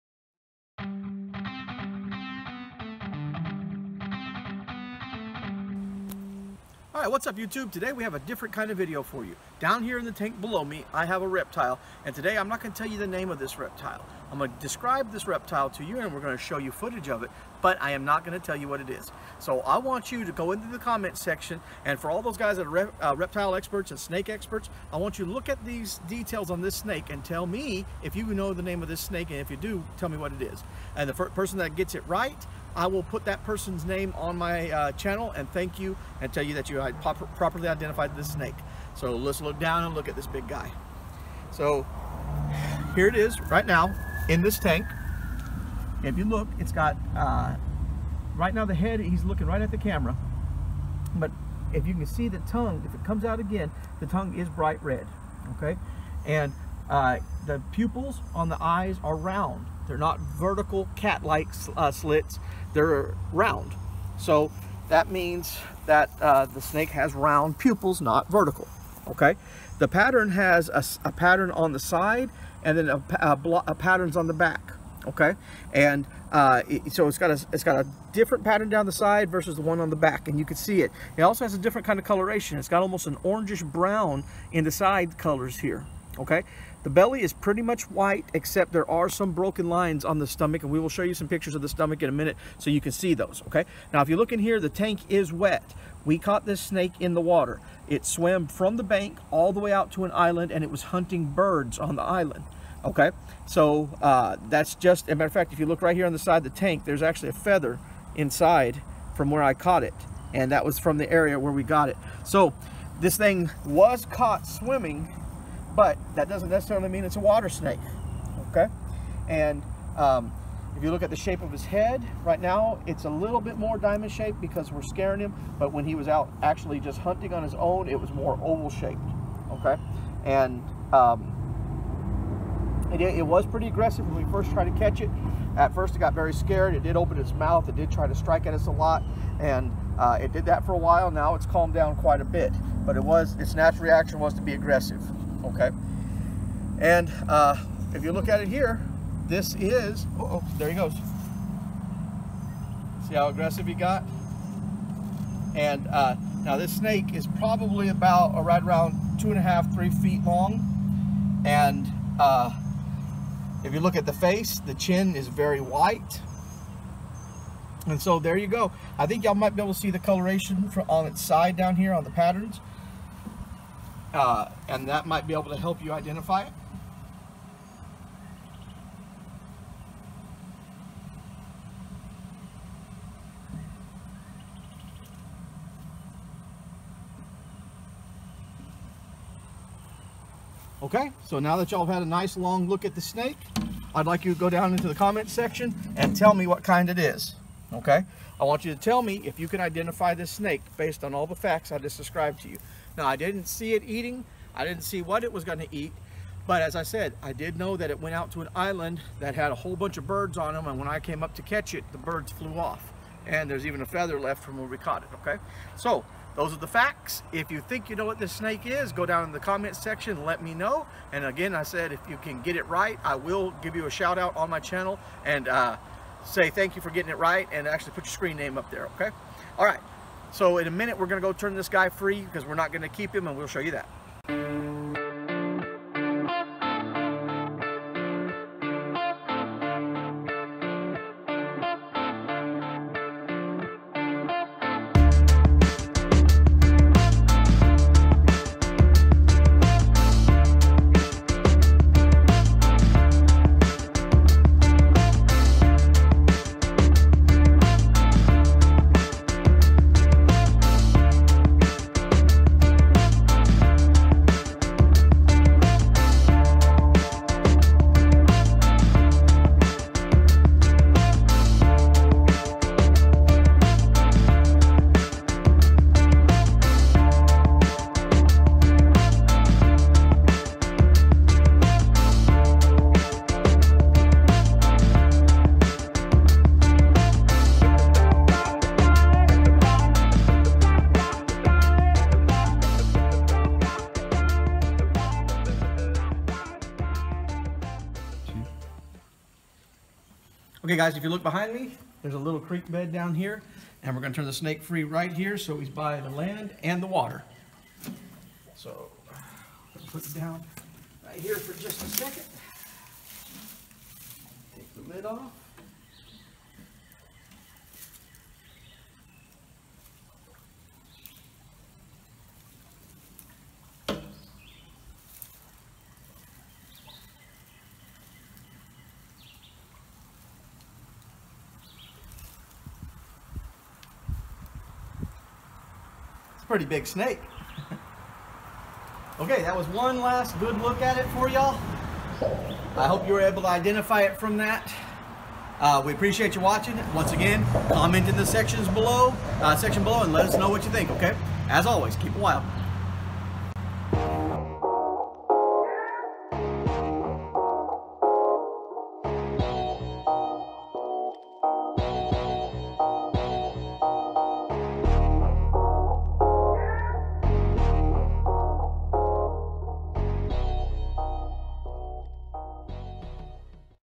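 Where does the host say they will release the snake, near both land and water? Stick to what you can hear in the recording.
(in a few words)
a little creek bed.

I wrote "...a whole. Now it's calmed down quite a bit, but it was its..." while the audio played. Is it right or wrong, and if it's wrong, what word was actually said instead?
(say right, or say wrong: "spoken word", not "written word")
wrong: "while", not "whole".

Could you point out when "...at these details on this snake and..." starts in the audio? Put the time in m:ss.
0:25.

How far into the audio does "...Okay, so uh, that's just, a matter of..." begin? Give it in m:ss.
1:42.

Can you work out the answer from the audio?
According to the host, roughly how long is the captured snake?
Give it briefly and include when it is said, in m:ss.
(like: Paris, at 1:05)
2.5 to 3 feet, at 2:39.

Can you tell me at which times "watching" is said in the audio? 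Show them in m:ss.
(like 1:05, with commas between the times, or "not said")
5:46.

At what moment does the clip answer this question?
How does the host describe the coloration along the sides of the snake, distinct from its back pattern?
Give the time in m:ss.
1:23.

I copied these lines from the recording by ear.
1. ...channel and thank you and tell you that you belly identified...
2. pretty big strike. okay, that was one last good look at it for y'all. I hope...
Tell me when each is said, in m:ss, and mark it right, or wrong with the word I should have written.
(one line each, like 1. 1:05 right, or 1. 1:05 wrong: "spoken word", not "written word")
1. 0:34 wrong: "properly", not "belly"
2. 5:36 wrong: "snake", not "strike".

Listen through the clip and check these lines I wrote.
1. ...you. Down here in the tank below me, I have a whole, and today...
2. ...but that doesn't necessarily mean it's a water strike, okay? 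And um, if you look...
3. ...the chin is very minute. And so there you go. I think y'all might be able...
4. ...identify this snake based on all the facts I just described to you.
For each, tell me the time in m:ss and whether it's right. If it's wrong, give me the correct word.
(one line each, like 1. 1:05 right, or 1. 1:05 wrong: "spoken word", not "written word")
1. 0:09 wrong: "reptile", not "whole"
2. 1:55 wrong: "snake", not "strike"
3. 2:44 wrong: "white", not "minute"
4. 3:19 right.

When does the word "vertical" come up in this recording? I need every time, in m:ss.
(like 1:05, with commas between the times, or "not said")
1:00, 1:08.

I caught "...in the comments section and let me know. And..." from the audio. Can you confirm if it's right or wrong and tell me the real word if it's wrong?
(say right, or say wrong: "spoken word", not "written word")
right.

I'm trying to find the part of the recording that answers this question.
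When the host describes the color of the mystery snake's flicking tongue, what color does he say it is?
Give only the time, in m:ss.
0:54.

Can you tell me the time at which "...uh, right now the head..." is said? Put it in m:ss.
0:47.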